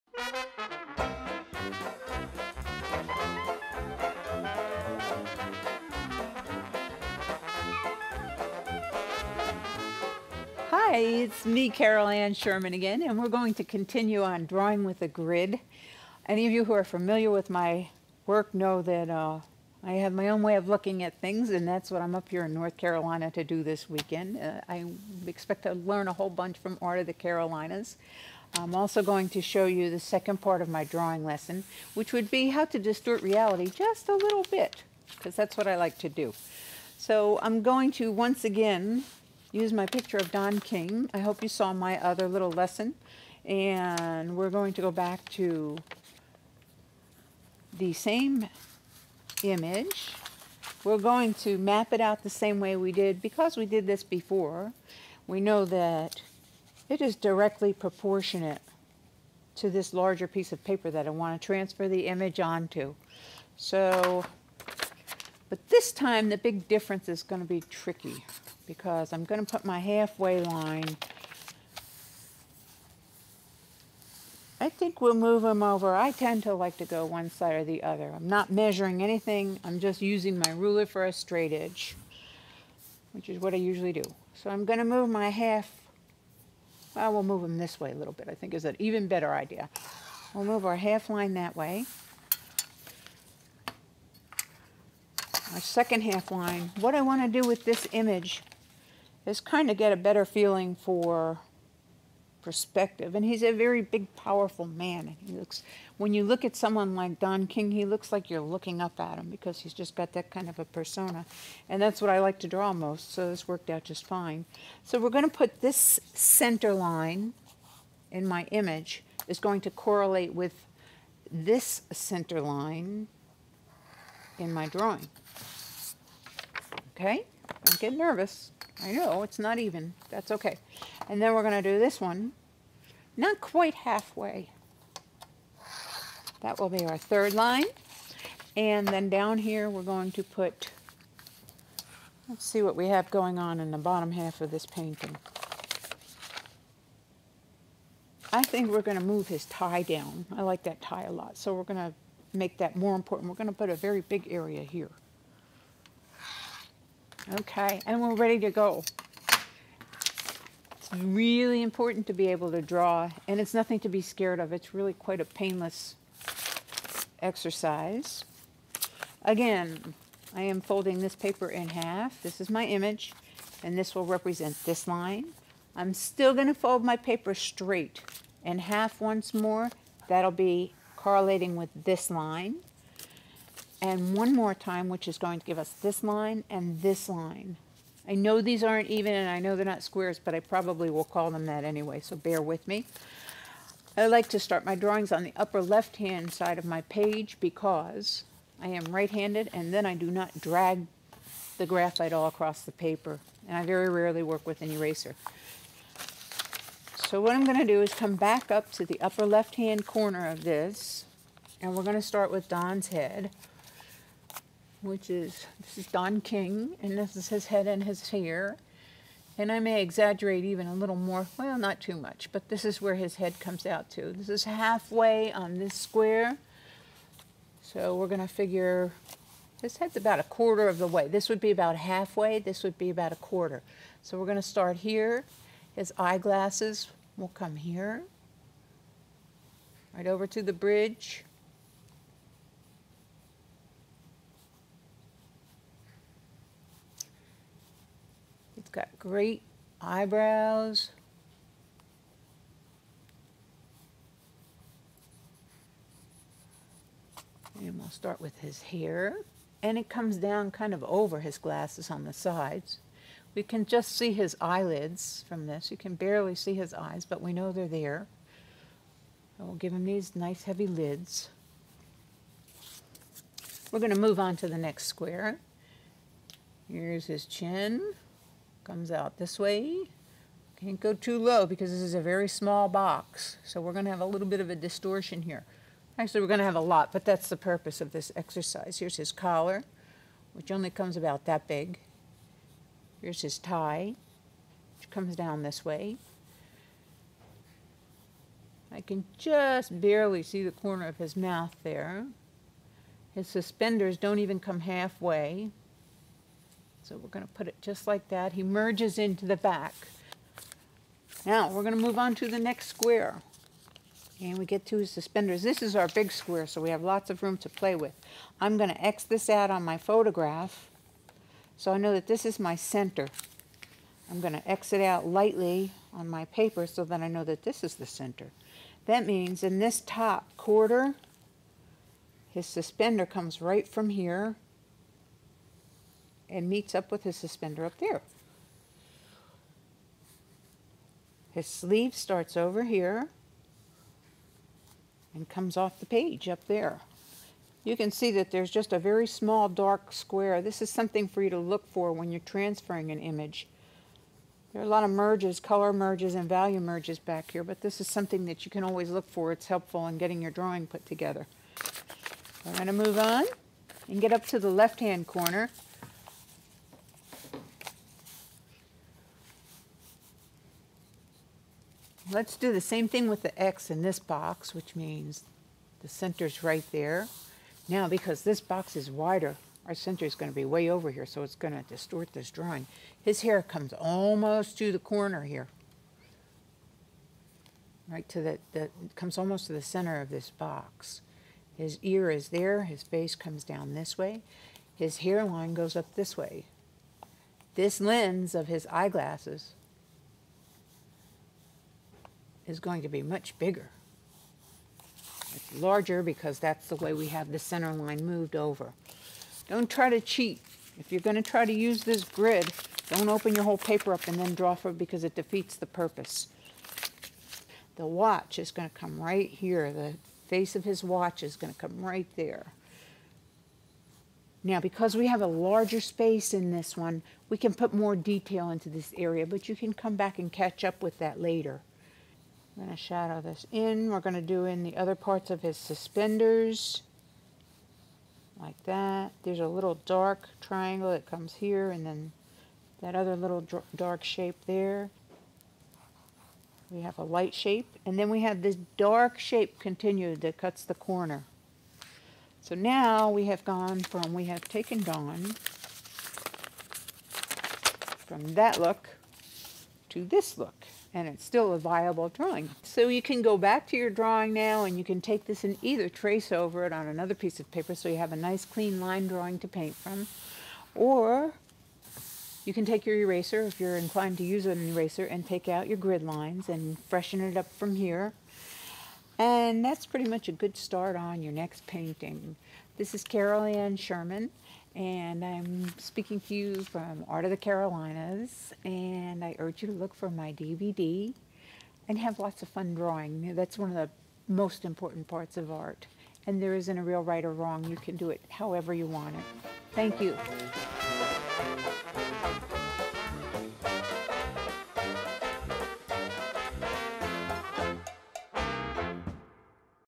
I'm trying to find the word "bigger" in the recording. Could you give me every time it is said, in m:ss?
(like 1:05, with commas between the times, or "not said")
6:43.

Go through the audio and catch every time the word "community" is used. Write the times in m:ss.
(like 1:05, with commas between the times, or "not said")
not said.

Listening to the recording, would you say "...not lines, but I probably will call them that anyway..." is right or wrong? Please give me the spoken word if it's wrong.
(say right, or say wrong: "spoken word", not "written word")
wrong: "squares", not "lines".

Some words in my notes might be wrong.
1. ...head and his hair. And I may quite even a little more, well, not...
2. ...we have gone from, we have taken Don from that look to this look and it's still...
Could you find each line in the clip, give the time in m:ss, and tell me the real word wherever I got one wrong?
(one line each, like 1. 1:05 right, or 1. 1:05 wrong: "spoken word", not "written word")
1. 3:37 wrong: "exaggerate", not "quite"
2. 7:33 right.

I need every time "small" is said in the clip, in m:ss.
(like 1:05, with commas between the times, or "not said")
4:42, 5:49.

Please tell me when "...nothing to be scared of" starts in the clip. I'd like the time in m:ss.
2:43.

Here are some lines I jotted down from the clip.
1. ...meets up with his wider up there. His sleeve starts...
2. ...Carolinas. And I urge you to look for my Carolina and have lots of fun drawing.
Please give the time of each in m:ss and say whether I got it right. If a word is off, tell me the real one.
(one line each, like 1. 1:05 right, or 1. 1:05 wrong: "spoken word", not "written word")
1. 5:36 wrong: "suspender", not "wider"
2. 8:07 wrong: "DVD", not "Carolina".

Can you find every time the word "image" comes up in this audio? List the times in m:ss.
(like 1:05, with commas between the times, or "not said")
0:49, 1:02, 1:37, 1:58, 2:52, 5:52.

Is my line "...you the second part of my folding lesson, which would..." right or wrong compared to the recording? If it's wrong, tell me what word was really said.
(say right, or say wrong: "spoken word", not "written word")
wrong: "drawing", not "folding".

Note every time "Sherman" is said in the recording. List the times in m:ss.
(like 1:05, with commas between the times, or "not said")
0:12, 8:03.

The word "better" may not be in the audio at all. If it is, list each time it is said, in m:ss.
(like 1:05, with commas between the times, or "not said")
1:29, 1:39.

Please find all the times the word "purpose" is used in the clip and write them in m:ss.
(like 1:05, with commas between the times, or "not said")
4:47, 6:55.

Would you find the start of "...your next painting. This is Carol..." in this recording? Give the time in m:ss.
8:01.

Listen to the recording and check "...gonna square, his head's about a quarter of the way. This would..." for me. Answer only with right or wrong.
wrong.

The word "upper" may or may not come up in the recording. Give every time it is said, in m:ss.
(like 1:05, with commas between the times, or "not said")
3:15, 3:29.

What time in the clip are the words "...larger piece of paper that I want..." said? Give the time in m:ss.
0:59.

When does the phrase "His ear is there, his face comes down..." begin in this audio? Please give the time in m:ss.
6:31.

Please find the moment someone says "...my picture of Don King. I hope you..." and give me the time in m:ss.
0:39.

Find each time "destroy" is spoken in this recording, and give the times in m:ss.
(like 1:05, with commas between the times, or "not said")
not said.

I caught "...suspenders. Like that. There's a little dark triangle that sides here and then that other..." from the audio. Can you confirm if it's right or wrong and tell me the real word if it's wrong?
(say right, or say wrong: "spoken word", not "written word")
wrong: "comes", not "sides".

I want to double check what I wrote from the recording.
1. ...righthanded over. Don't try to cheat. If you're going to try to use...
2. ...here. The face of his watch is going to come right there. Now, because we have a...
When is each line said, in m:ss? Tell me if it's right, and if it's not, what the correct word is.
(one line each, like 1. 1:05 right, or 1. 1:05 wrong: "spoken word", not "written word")
1. 6:48 wrong: "moved", not "righthanded"
2. 6:59 right.